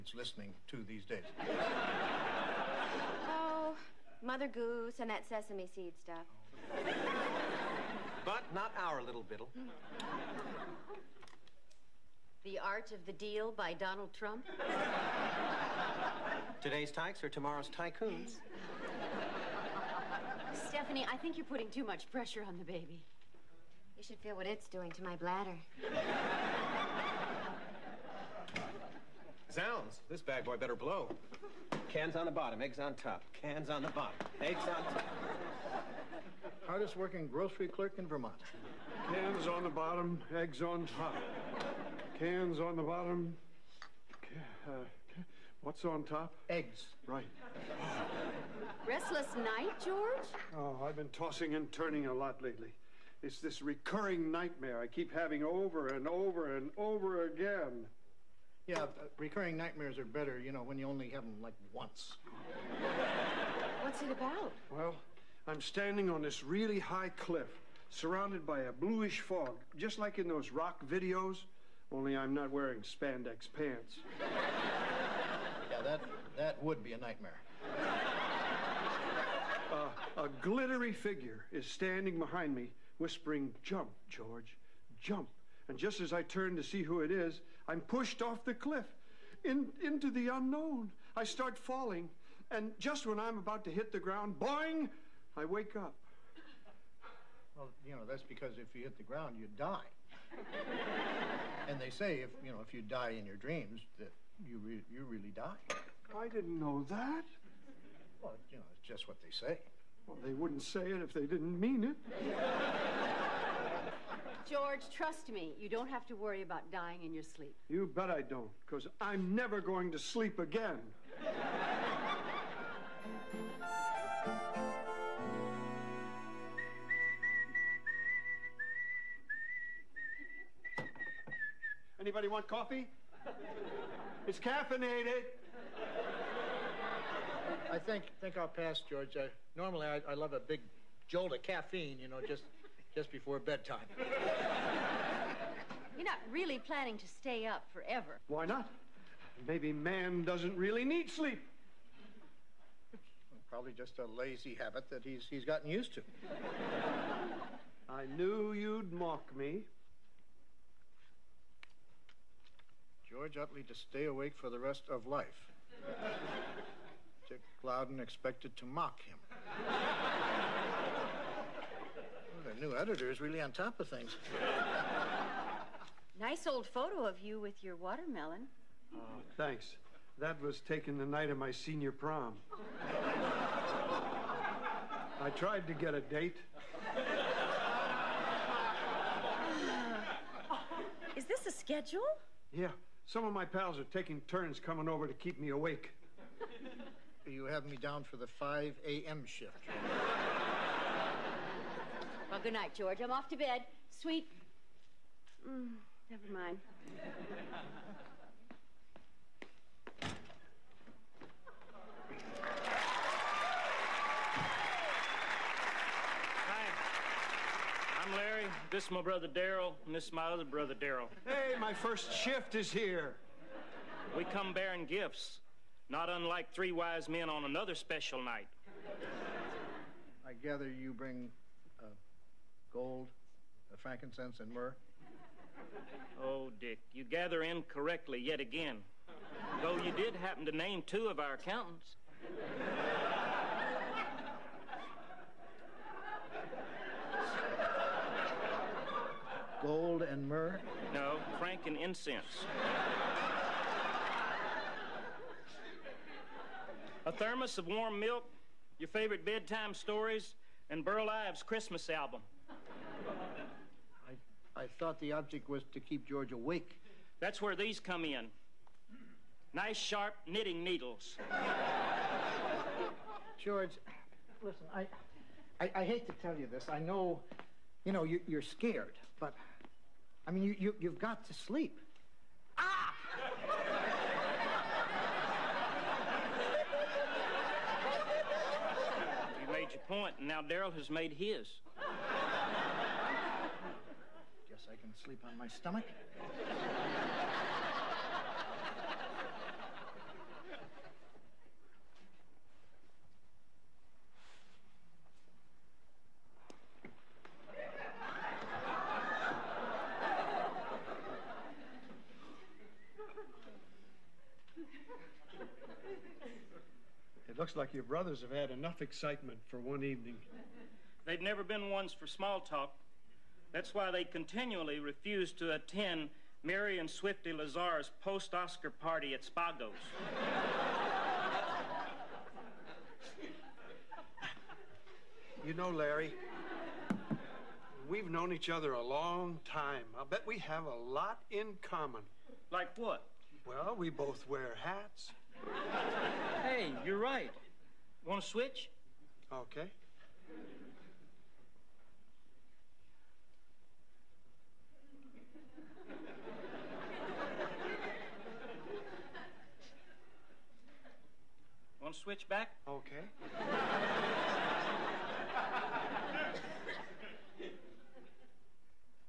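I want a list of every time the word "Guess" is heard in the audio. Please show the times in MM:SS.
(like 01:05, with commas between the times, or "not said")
04:51.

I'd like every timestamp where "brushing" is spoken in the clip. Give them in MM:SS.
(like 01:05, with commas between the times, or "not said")
not said.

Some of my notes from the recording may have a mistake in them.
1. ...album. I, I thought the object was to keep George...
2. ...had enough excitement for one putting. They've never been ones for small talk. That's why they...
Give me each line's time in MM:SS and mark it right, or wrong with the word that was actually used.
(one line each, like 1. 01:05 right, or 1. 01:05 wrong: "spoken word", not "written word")
1. 04:21 right
2. 05:18 wrong: "evening", not "putting".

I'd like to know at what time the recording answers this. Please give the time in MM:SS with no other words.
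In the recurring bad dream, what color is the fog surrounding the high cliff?
01:08.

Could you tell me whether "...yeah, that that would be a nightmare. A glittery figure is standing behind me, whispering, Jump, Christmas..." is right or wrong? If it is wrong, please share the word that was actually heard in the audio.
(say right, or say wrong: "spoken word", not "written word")
wrong: "George", not "Christmas".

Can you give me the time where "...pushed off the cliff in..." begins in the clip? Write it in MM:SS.
01:27.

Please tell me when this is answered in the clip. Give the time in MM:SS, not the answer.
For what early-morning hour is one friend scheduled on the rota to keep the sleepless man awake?
03:18.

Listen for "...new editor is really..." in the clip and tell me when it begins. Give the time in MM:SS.
02:52.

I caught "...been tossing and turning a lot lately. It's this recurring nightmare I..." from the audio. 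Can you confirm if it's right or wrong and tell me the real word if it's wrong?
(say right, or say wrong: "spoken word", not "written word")
right.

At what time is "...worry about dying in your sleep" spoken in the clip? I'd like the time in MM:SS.
01:56.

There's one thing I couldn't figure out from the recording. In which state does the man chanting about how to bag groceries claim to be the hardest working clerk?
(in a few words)
Vermont.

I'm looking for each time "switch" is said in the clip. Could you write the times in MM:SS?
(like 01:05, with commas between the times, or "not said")
05:48, 06:01.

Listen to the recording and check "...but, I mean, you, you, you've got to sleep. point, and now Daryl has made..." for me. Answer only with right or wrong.
right.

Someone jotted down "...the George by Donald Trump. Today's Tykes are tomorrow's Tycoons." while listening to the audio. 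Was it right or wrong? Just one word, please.
wrong.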